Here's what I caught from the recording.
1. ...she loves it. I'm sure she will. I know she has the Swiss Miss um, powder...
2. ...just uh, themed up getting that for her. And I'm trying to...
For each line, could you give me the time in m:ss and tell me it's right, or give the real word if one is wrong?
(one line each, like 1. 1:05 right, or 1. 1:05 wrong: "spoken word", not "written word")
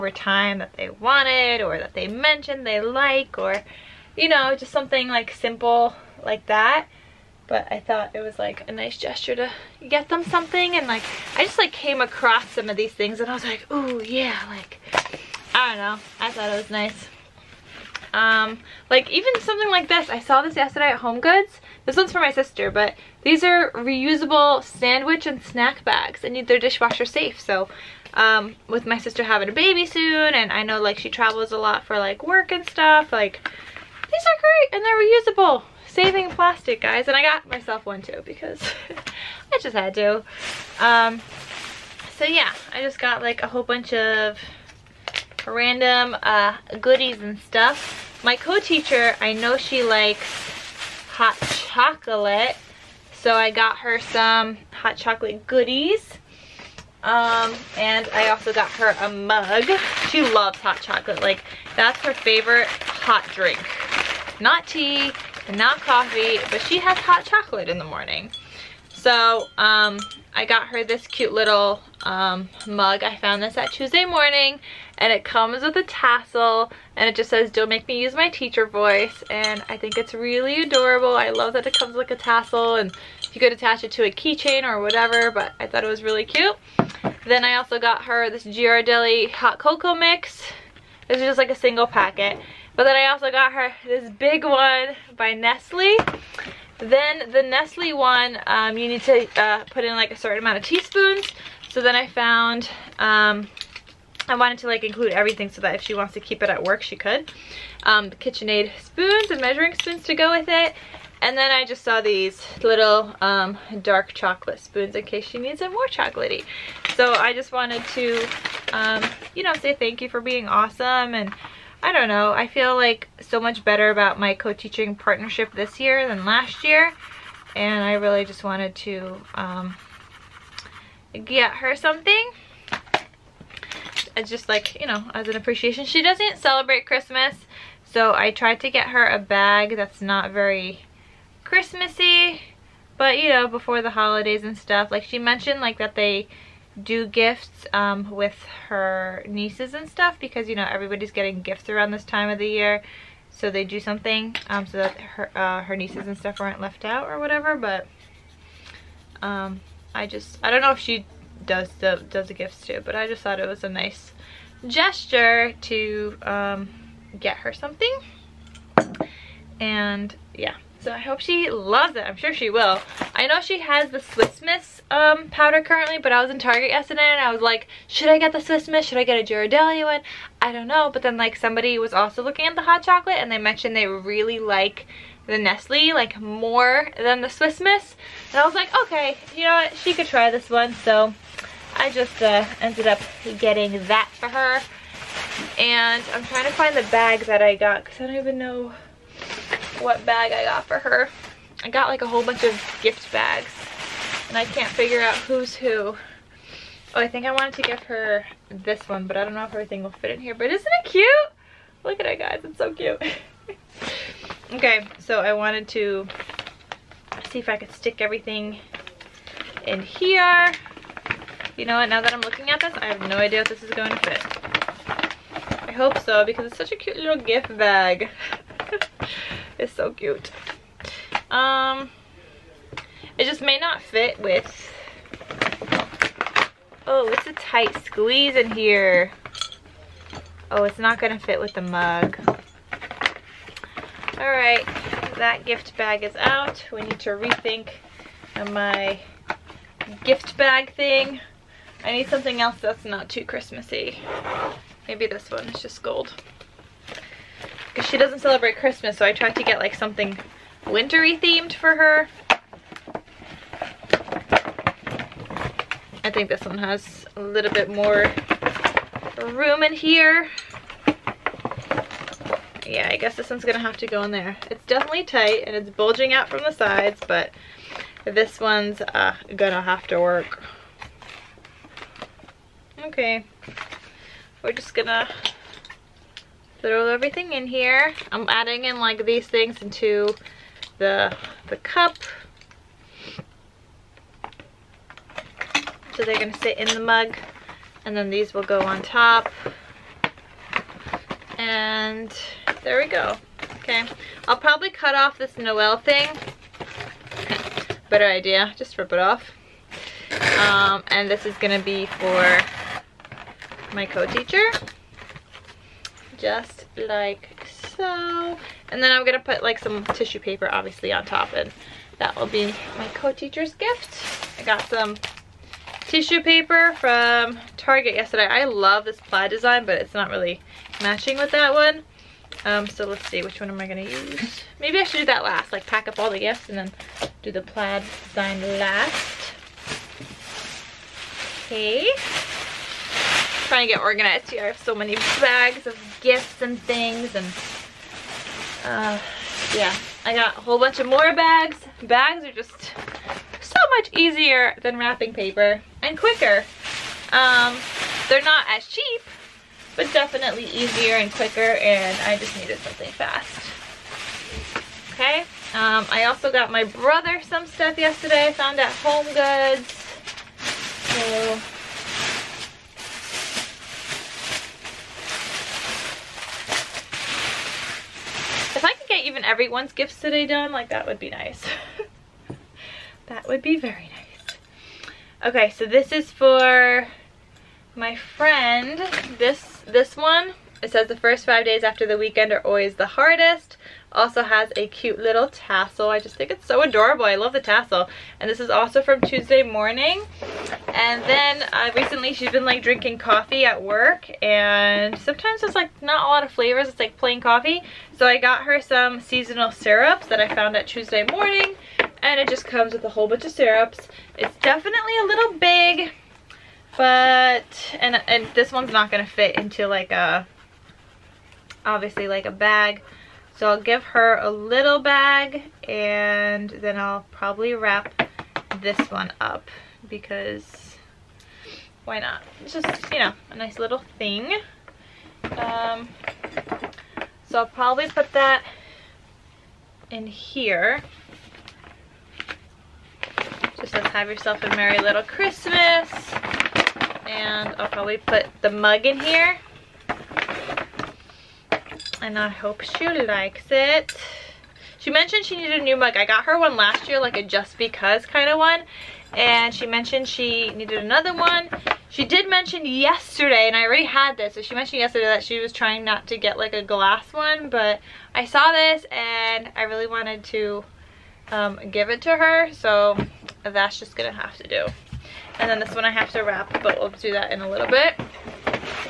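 1. 2:51 right
2. 3:11 wrong: "ended", not "themed".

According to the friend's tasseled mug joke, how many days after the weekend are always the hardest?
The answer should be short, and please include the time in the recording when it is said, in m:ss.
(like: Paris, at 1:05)
5, at 6:31.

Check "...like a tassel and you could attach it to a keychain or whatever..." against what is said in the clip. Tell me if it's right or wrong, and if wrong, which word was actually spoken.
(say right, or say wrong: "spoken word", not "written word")
right.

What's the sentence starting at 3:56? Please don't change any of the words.
Oh, it's a tight squeeze in here.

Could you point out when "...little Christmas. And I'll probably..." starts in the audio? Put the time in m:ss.
7:24.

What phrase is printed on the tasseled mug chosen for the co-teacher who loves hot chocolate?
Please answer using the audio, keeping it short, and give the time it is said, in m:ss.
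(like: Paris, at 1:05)
Don't make me use my teacher voice, at 1:17.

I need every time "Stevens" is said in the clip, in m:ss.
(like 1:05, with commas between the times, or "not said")
not said.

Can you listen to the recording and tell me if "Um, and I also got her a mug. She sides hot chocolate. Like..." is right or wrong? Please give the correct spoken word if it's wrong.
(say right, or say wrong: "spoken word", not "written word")
wrong: "loves", not "sides".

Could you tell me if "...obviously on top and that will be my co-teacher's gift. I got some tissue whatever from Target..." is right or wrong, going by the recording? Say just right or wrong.
wrong.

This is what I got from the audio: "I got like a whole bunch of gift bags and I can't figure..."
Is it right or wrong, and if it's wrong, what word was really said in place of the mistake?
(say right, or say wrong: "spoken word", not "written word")
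right.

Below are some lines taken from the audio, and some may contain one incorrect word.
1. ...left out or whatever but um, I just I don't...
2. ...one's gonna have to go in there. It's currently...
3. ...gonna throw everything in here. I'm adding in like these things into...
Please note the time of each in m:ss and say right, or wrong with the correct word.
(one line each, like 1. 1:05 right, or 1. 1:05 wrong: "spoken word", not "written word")
1. 2:36 right
2. 4:33 wrong: "definitely", not "currently"
3. 4:44 right.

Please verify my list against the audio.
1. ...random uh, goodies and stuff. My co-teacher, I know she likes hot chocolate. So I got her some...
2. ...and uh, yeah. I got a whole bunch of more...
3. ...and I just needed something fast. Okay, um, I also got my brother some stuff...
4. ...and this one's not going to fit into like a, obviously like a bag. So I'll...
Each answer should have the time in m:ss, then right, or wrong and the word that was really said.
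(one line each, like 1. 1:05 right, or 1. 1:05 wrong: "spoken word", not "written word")
1. 0:45 right
2. 5:47 right
3. 6:01 right
4. 6:58 right.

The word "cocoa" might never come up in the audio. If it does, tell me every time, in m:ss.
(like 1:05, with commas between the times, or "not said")
1:29.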